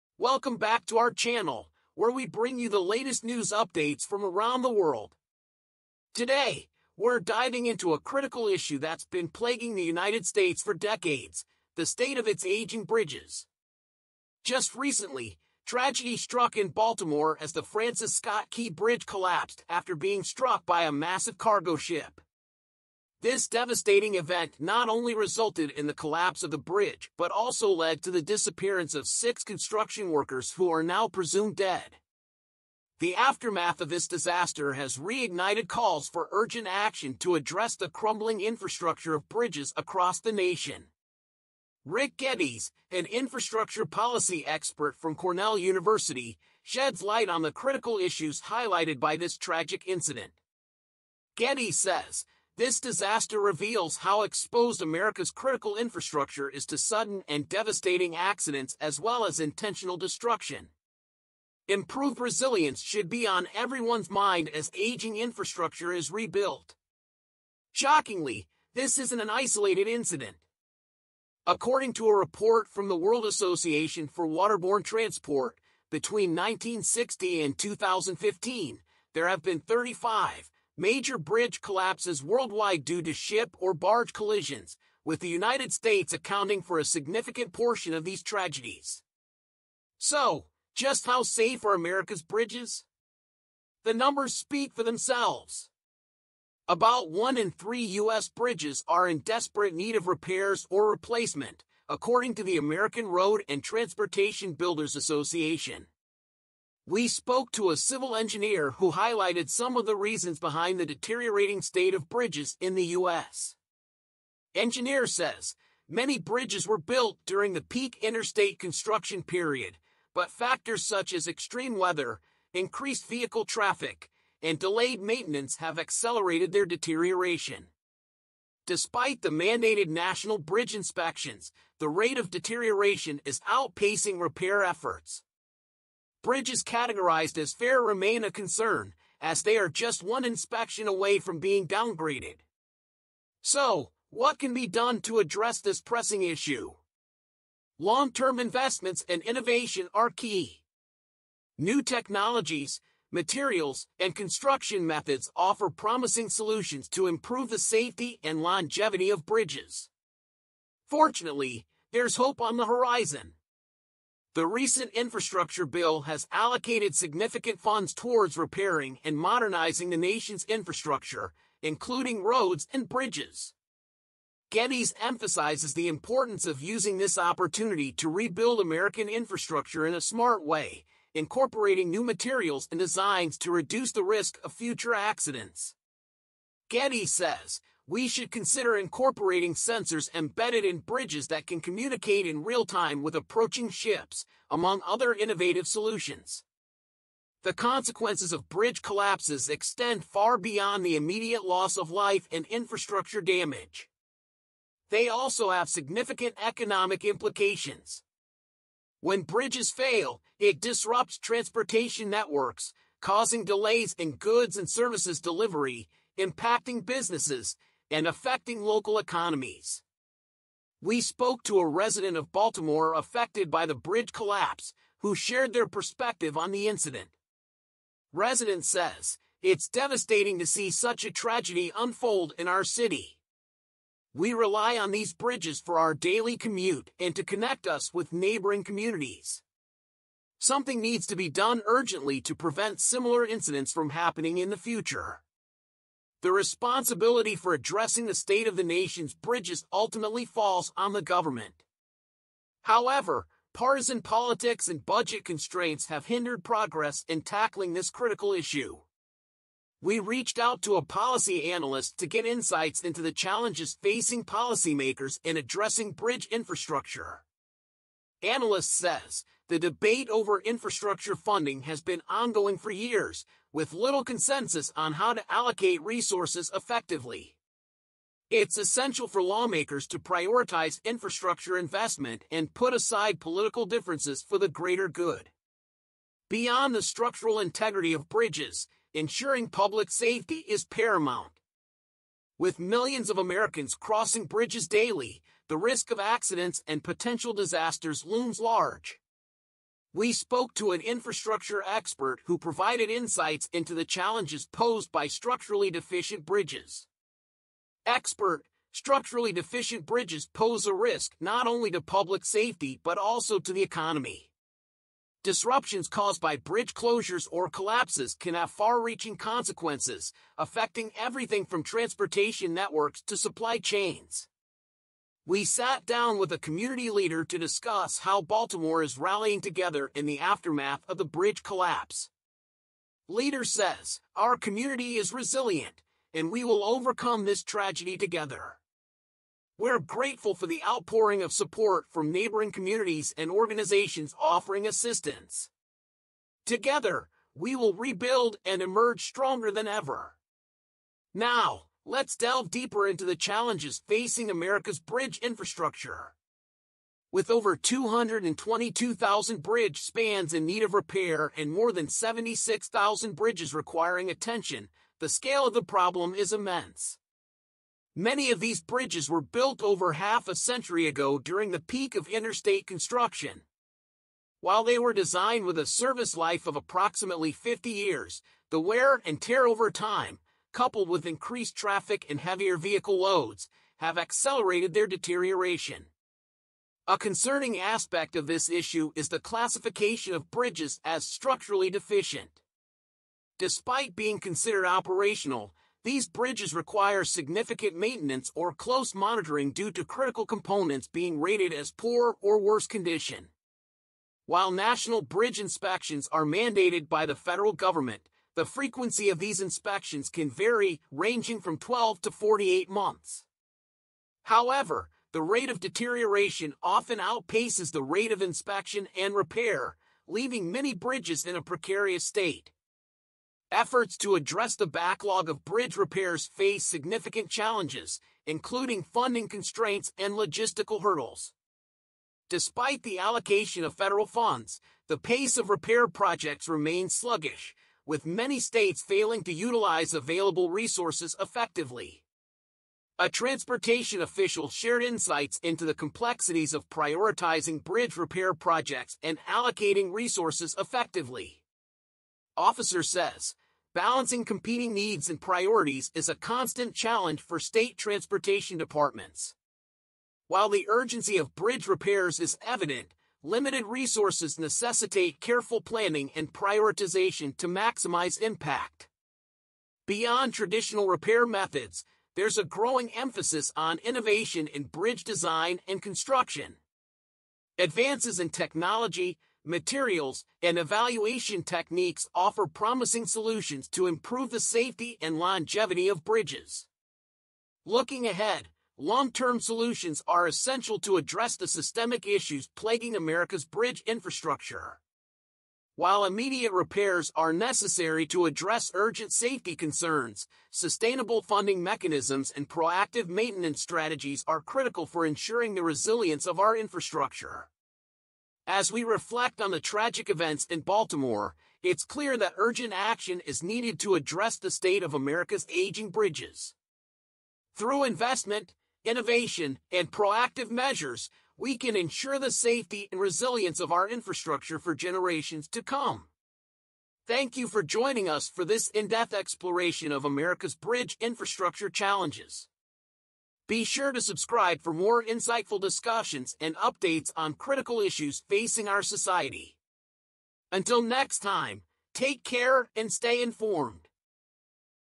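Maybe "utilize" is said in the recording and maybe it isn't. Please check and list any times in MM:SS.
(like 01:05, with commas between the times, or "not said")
07:19.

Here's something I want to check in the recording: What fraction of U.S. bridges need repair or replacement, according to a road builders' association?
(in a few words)
1 in 3.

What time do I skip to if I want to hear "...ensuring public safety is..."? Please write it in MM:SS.
04:48.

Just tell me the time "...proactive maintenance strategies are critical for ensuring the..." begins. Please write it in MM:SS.
08:22.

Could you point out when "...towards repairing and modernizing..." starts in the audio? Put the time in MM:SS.
02:47.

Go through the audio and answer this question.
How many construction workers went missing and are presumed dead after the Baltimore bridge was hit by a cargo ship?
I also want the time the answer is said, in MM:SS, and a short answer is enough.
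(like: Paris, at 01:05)
6, at 00:29.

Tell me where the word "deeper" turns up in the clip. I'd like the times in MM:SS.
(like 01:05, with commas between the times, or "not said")
05:52.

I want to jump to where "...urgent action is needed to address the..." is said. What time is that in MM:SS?
08:32.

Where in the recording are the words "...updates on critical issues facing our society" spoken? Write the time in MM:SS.
08:56.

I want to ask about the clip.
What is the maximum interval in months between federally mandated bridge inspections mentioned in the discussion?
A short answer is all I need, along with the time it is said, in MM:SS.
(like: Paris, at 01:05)
48 months, at 06:52.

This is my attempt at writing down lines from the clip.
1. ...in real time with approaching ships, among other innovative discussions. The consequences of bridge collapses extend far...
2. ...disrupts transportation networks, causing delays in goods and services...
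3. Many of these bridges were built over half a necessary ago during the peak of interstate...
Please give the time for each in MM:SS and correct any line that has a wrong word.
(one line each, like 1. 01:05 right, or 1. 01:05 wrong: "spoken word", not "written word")
1. 03:12 wrong: "solutions", not "discussions"
2. 03:30 right
3. 06:07 wrong: "century", not "necessary".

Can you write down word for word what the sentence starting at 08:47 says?
Thank you for joining us for this in-depth exploration of America's bridge infrastructure challenges.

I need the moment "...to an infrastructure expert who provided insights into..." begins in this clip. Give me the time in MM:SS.
05:00.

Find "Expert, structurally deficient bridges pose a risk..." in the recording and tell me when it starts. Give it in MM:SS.
05:07.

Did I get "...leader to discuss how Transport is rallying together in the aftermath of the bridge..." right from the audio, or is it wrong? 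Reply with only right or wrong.
wrong.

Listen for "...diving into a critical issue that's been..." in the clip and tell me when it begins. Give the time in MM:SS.
00:07.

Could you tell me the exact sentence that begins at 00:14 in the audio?
Just recently, tragedy struck in Baltimore as the Francis Scott Key Bridge collapsed after being struck by a massive cargo ship.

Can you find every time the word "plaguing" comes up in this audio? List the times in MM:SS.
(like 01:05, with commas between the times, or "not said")
00:09, 08:12.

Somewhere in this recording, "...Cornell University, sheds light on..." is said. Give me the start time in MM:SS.
00:45.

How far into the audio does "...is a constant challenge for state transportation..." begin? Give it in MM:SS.
07:35.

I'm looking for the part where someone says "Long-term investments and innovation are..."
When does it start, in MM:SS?
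02:27.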